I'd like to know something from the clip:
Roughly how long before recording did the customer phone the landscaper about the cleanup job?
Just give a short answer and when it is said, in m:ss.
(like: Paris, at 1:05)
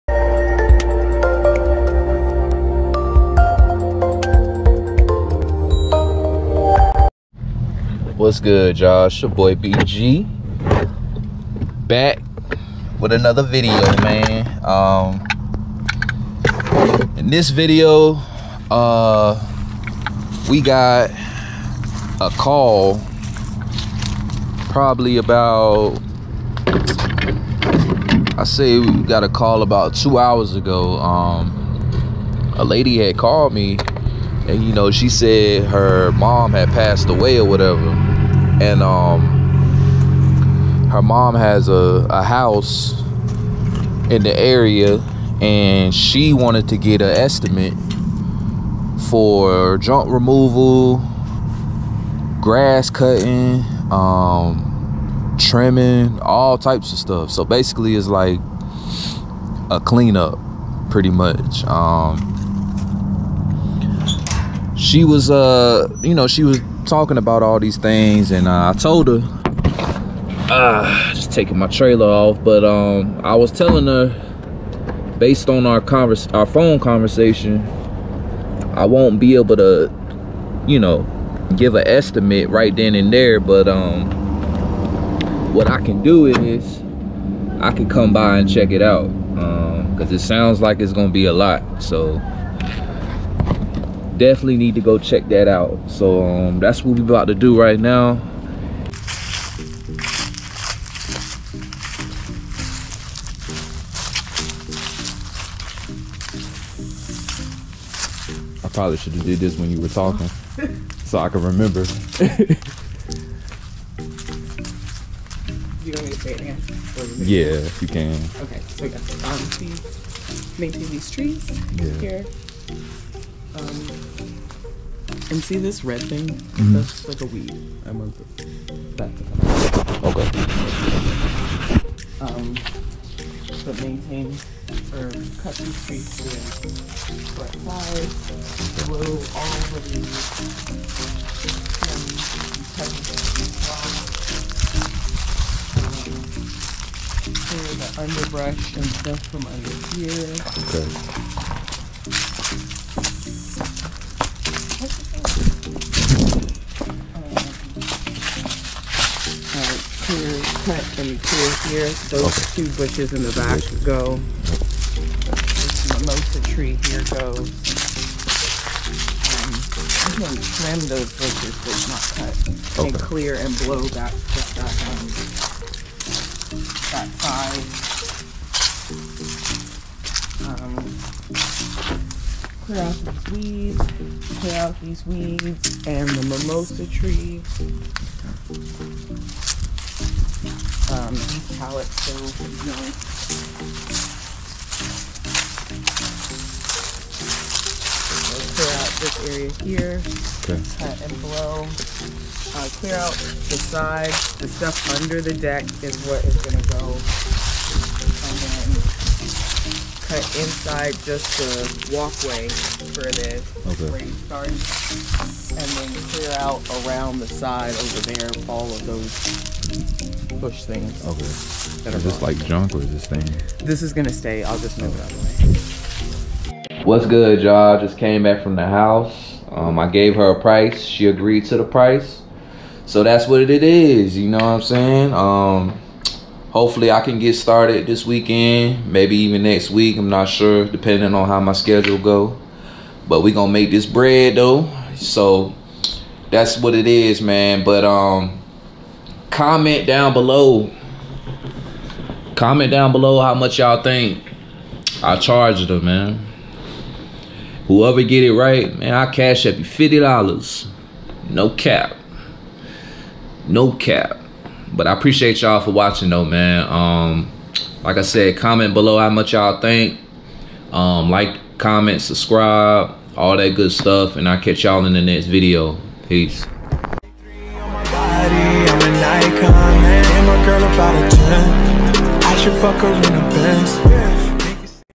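2 hours, at 0:29.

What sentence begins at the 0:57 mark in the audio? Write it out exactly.
So basically, it's like a cleanup, pretty much.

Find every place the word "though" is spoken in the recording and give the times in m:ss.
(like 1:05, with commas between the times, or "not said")
4:04, 4:26.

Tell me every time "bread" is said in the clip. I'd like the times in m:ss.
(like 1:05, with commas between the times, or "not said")
4:03.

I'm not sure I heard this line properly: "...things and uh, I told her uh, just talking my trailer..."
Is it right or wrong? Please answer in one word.
wrong.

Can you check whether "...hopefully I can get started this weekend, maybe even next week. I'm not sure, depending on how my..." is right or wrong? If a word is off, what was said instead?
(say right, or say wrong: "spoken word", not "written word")
right.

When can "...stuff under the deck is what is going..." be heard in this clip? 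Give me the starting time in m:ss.
3:24.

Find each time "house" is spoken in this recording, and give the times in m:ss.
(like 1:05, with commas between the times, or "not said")
0:42, 3:48.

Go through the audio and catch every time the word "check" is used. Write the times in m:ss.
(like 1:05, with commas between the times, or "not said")
1:28, 1:34.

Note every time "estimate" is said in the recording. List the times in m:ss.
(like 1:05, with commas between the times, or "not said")
0:47, 1:21.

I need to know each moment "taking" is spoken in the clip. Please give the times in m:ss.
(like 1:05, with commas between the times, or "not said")
1:11.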